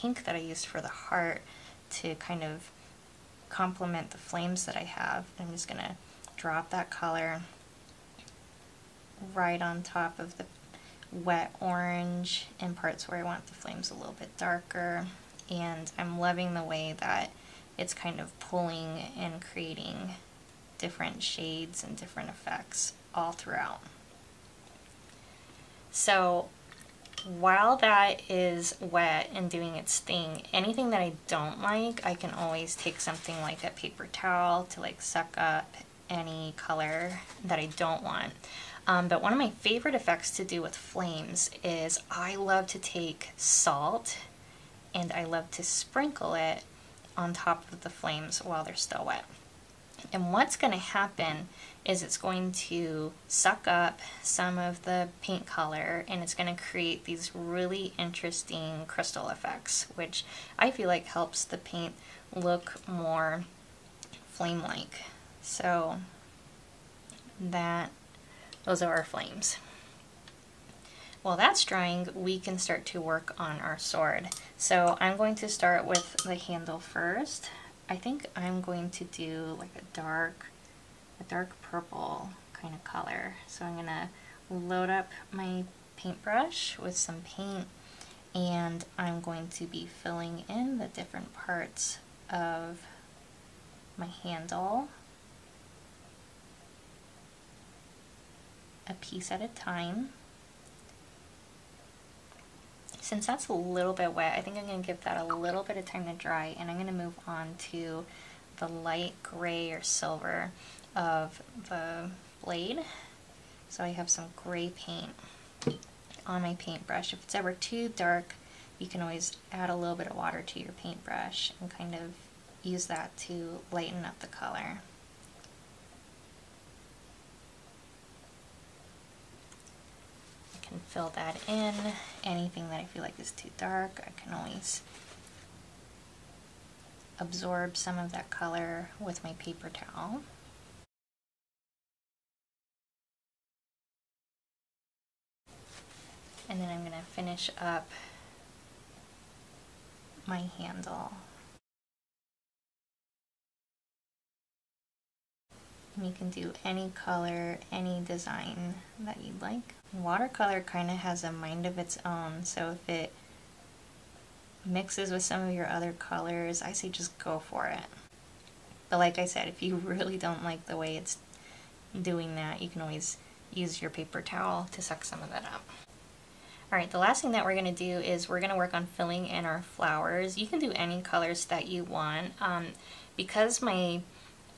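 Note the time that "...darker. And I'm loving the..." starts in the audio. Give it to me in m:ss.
0:14.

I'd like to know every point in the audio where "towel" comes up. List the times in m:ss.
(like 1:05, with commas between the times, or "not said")
0:34, 2:19, 2:54.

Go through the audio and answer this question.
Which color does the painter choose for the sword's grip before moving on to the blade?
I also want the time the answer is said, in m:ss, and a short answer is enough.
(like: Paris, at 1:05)
Dark purple, at 1:21.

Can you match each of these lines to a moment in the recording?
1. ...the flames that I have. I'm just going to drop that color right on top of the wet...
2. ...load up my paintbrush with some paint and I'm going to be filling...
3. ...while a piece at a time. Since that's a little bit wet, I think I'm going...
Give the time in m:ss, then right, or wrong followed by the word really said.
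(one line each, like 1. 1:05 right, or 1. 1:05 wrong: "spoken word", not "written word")
1. 0:04 right
2. 1:24 right
3. 1:34 wrong: "handle", not "while".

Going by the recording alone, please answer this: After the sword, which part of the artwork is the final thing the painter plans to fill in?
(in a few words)
Flowers.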